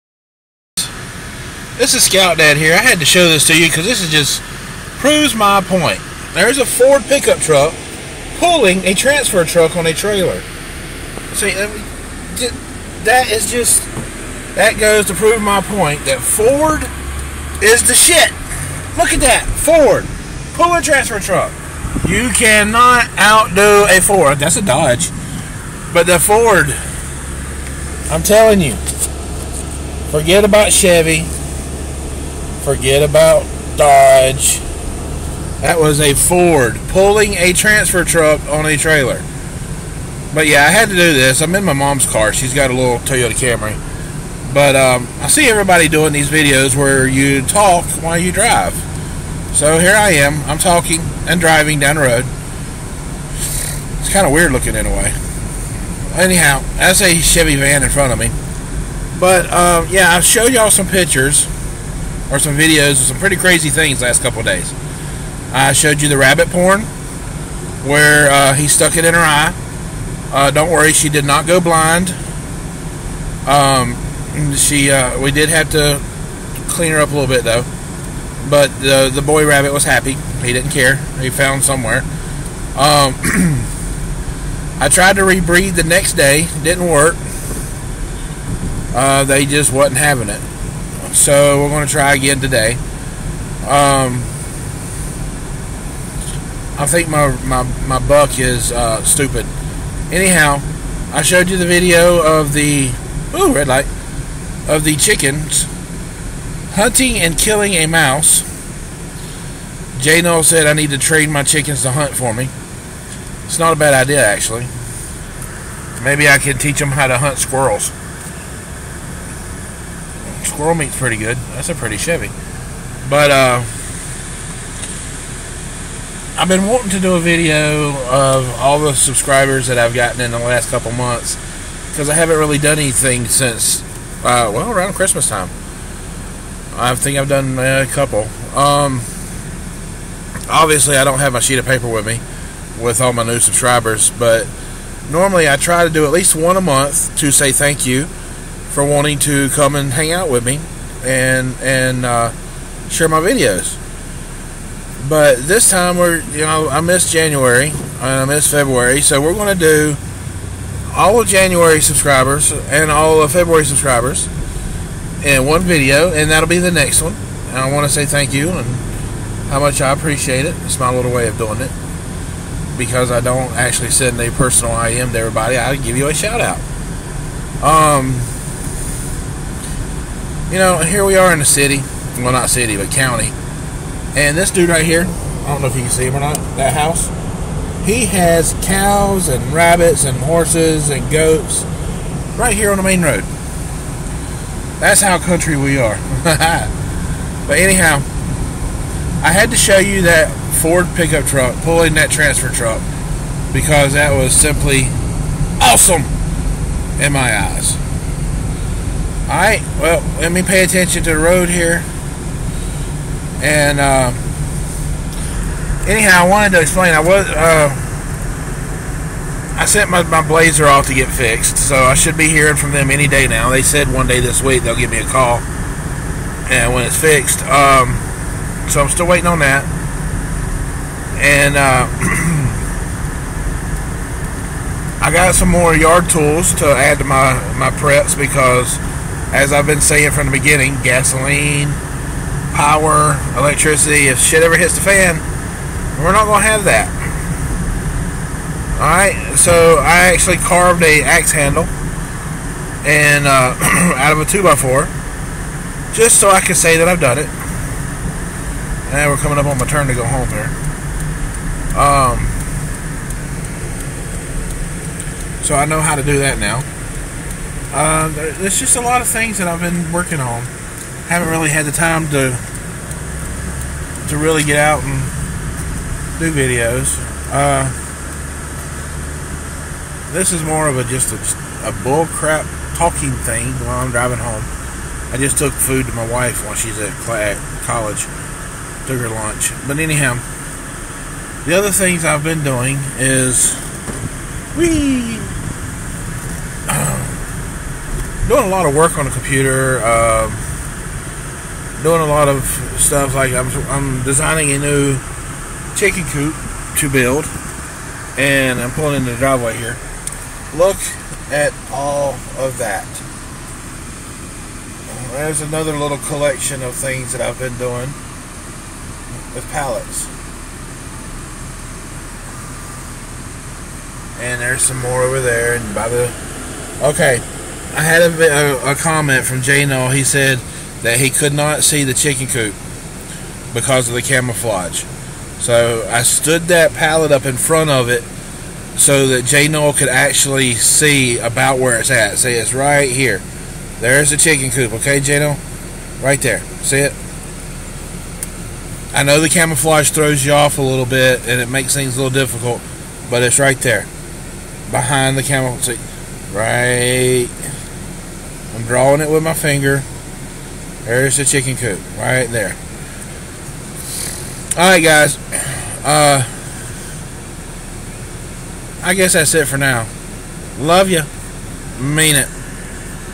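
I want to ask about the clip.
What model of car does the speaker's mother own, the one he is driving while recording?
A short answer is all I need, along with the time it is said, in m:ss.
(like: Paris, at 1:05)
Toyota Camry, at 0:42.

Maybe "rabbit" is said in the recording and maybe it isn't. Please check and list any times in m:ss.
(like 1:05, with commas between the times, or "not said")
1:06, 1:19, 3:09.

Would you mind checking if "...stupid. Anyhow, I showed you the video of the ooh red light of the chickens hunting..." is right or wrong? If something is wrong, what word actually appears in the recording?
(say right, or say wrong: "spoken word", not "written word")
right.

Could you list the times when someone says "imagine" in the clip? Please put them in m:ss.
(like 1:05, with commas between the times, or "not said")
not said.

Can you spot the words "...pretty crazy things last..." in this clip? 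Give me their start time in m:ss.
1:03.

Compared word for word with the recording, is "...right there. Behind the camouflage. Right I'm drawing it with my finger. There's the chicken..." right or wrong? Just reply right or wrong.
right.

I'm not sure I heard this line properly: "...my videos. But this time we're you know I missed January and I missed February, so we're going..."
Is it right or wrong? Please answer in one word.
right.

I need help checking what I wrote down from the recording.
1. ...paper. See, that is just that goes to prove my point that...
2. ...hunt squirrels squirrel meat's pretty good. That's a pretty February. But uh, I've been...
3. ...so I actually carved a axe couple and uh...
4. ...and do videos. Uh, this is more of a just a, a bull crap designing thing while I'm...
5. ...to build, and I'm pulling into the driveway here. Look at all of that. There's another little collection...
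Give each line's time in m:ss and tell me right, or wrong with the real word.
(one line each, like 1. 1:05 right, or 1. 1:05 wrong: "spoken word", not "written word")
1. 0:09 wrong: "trailer", not "paper"
2. 1:57 wrong: "Chevy", not "February"
3. 4:09 wrong: "handle", not "couple"
4. 4:34 wrong: "talking", not "designing"
5. 5:06 right.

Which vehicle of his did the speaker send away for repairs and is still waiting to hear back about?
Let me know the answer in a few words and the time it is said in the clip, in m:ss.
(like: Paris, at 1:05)
Blazer, at 3:40.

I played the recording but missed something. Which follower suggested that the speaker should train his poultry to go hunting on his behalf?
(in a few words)
Jay Noel.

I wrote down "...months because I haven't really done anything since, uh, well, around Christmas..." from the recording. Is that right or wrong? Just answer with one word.
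right.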